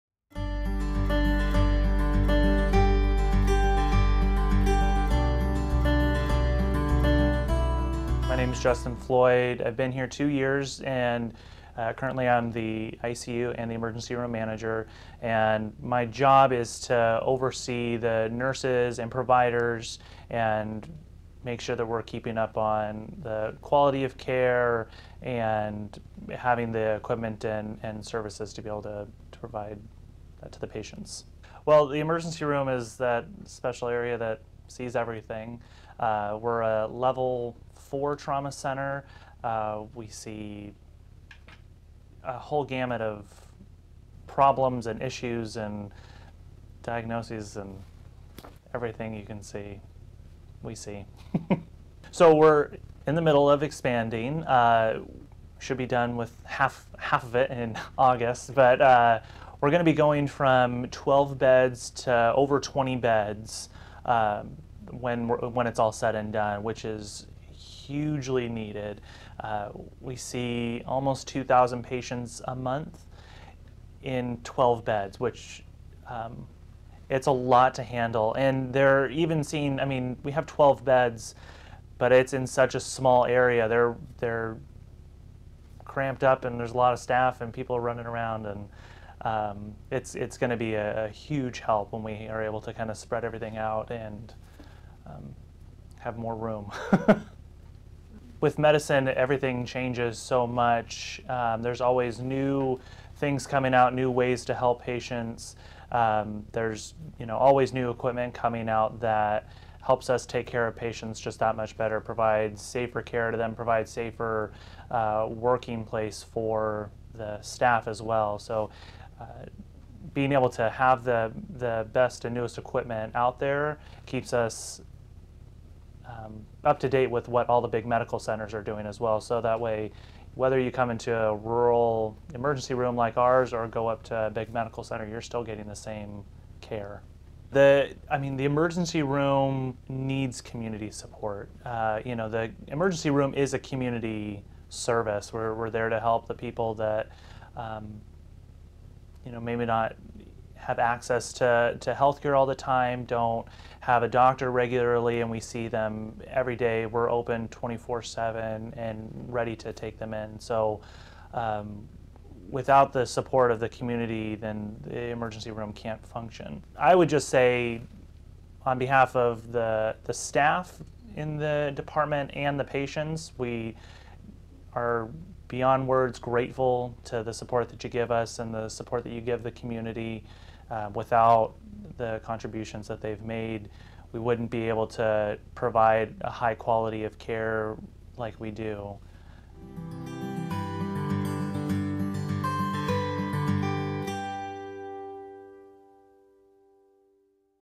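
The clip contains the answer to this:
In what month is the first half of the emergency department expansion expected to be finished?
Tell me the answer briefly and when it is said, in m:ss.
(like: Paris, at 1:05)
August, at 0:57.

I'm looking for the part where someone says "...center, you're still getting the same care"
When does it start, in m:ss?
2:14.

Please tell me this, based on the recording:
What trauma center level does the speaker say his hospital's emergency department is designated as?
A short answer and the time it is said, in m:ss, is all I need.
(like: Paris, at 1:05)
Level 4, at 0:36.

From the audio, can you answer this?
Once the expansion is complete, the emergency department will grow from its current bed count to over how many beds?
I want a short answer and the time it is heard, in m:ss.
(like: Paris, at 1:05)
20, at 1:02.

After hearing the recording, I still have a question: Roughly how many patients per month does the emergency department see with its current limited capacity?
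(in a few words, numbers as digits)
2,000.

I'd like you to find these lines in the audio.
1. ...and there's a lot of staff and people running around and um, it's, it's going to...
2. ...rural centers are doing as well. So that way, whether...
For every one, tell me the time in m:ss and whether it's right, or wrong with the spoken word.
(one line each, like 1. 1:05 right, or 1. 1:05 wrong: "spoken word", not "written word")
1. 1:26 right
2. 2:07 wrong: "medical", not "rural".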